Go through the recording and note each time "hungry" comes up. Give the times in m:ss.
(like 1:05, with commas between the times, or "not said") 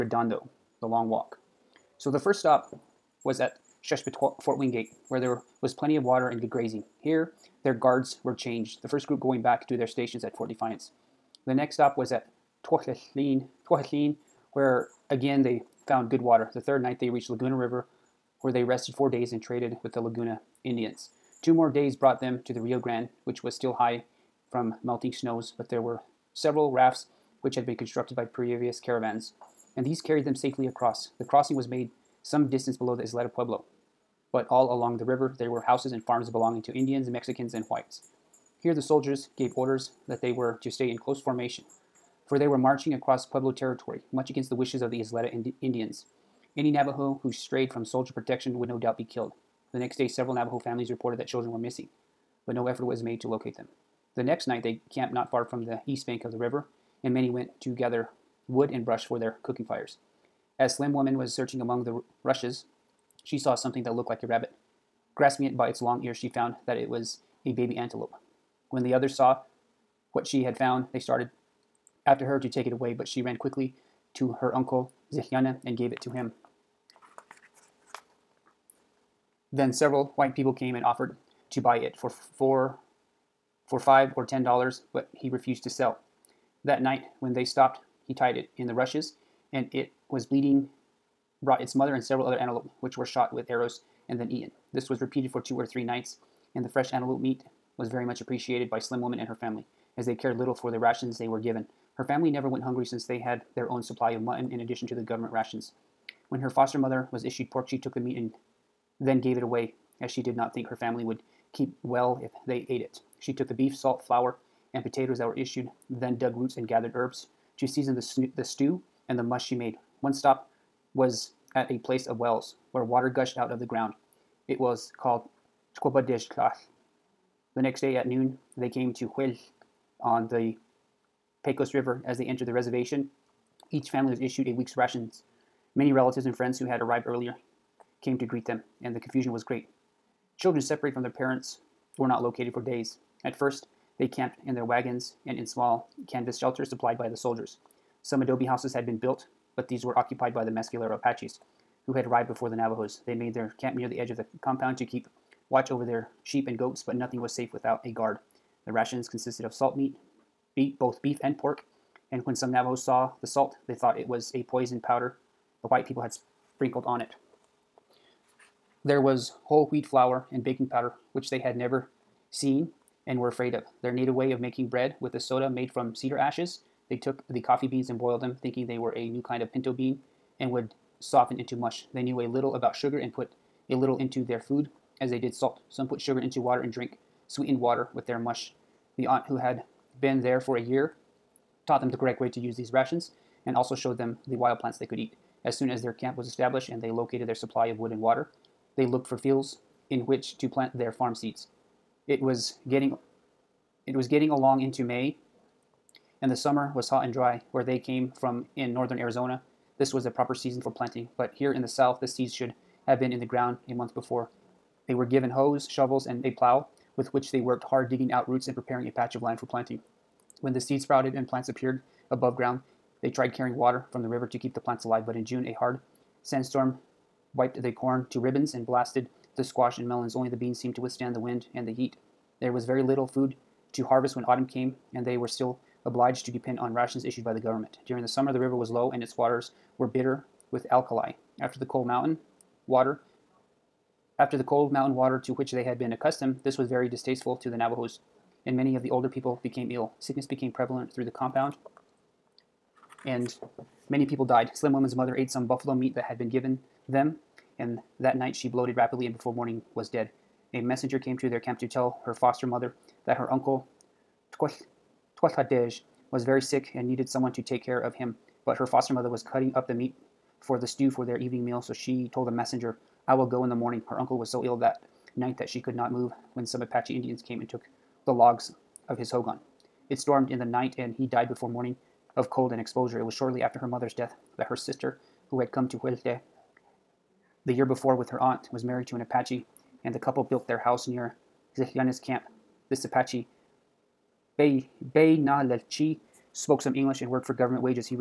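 1:42.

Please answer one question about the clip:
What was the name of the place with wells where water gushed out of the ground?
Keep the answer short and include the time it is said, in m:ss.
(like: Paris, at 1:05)
Tkobadishklath, at 2:05.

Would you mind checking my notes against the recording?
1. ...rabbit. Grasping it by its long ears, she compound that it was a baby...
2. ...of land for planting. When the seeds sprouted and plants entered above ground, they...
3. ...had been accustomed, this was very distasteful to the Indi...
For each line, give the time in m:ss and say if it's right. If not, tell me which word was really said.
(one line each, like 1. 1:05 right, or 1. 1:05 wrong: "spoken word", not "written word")
1. 1:04 wrong: "found", not "compound"
2. 3:39 wrong: "appeared", not "entered"
3. 4:05 wrong: "Navajos", not "Indi".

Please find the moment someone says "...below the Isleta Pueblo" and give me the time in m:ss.
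0:32.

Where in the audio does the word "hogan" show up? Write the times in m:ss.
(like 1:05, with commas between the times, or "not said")
4:39.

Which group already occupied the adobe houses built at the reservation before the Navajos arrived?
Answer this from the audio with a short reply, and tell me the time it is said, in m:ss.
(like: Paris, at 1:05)
Mescalero Apaches, at 2:30.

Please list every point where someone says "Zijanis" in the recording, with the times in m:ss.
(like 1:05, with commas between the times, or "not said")
4:51.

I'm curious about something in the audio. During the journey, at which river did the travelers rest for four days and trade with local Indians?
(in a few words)
Laguna River.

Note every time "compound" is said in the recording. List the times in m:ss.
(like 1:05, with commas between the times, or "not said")
2:34, 4:11.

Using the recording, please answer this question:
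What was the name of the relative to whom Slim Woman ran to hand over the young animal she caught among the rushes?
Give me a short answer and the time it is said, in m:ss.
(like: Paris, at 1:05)
Zichyana, at 1:15.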